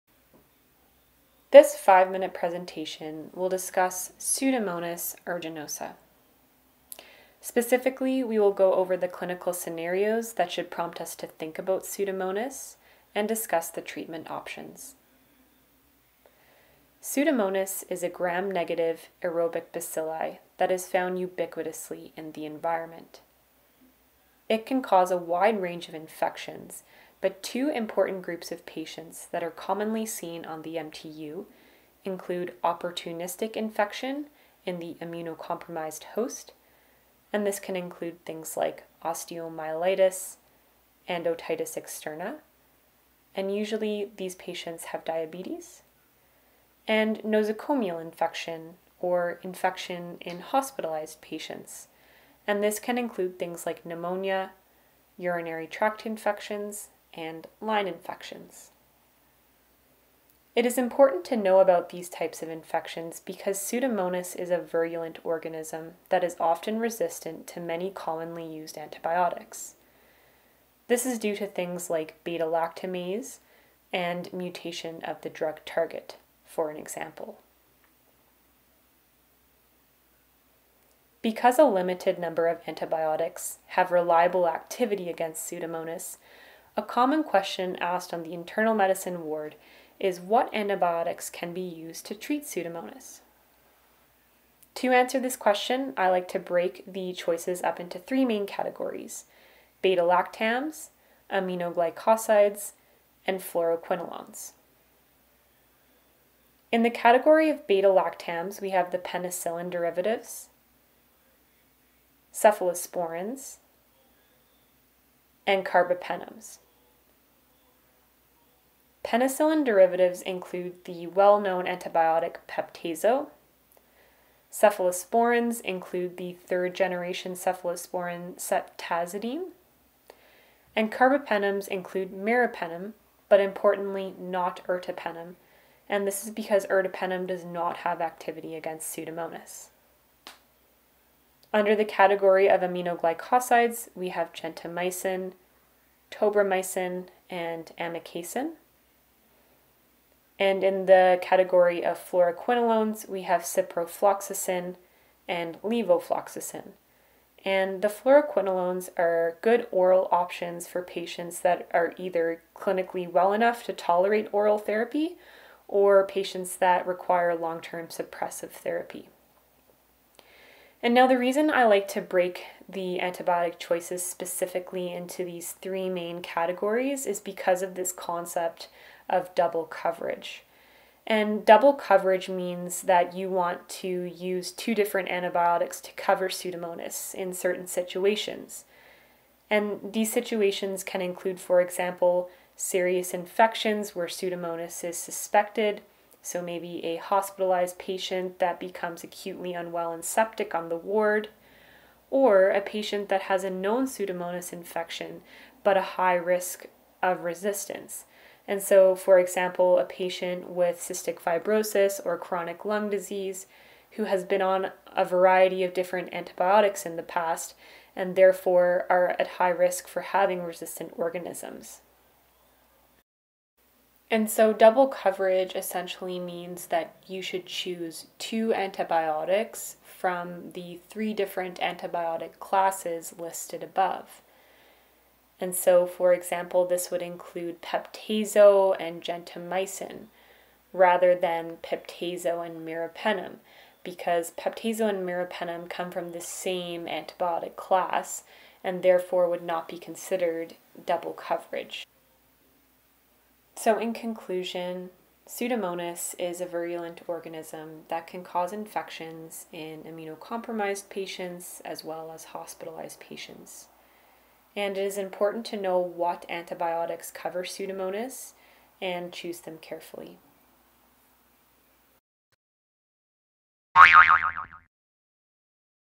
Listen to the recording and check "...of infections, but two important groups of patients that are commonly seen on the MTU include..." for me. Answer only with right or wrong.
right.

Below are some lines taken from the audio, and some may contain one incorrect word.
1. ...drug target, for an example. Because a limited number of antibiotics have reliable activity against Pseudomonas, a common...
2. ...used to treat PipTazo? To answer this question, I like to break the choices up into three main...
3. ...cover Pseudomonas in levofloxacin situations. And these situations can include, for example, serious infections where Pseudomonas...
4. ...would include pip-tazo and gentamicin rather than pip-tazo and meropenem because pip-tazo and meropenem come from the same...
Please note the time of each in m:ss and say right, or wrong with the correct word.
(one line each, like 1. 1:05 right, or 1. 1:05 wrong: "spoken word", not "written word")
1. 1:15 right
2. 1:31 wrong: "Pseudomonas", not "PipTazo"
3. 3:05 wrong: "certain", not "levofloxacin"
4. 3:56 right.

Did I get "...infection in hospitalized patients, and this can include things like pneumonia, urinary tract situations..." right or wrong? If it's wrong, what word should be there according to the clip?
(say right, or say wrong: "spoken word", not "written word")
wrong: "infections", not "situations".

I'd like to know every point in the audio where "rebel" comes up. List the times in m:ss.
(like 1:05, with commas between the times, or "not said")
not said.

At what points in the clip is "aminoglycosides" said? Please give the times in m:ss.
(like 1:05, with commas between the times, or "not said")
1:41, 2:22.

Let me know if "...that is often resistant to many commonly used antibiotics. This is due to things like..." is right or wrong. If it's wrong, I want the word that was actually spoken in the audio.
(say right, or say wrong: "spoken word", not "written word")
right.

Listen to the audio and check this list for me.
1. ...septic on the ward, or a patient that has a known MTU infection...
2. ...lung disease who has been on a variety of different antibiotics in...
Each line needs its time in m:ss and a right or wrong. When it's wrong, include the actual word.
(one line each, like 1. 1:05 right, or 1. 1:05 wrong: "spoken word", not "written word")
1. 3:20 wrong: "Pseudomonas", not "MTU"
2. 3:32 right.